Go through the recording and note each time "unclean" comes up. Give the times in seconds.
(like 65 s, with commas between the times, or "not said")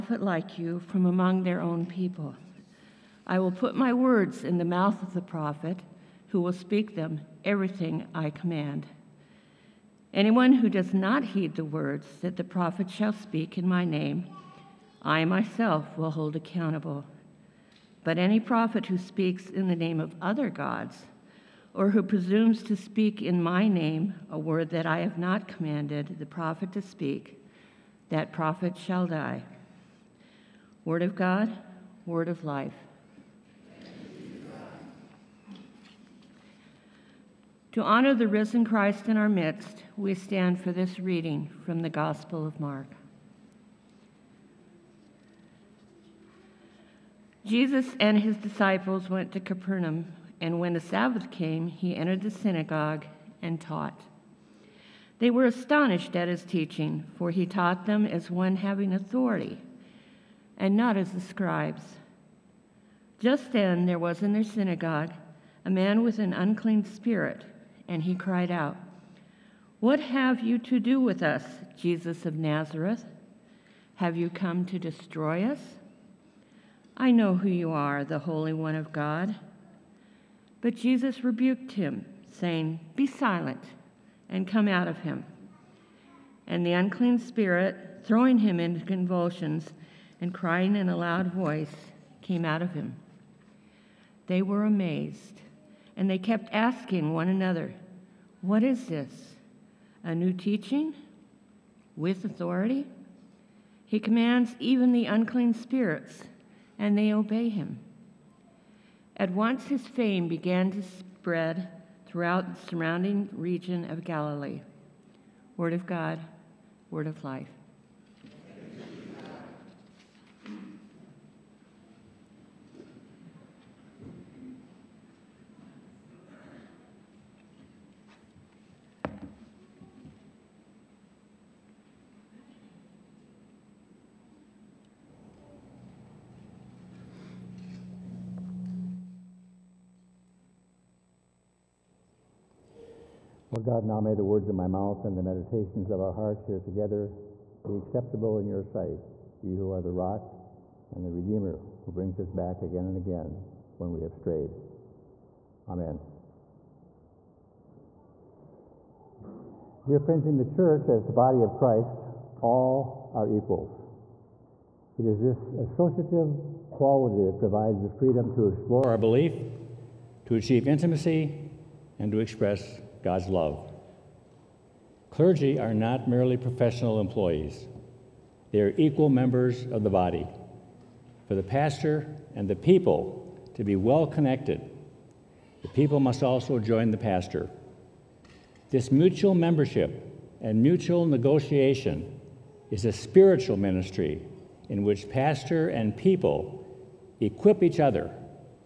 66 s, 86 s, 105 s.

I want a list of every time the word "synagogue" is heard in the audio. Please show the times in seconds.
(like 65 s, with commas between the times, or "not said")
52 s, 64 s.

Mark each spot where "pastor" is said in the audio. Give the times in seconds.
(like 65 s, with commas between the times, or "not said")
181 s, 186 s, 195 s.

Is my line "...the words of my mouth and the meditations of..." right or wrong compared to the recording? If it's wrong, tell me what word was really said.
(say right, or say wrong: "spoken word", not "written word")
right.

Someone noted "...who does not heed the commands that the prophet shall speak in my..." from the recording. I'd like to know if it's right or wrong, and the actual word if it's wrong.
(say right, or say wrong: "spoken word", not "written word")
wrong: "words", not "commands".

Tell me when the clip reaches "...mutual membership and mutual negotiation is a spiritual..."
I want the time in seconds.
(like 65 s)
188 s.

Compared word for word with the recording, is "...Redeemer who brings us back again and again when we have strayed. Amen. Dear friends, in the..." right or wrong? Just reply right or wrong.
right.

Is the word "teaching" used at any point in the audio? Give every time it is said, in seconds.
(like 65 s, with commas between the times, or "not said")
56 s, 100 s.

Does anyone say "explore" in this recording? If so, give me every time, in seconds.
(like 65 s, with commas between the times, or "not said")
168 s.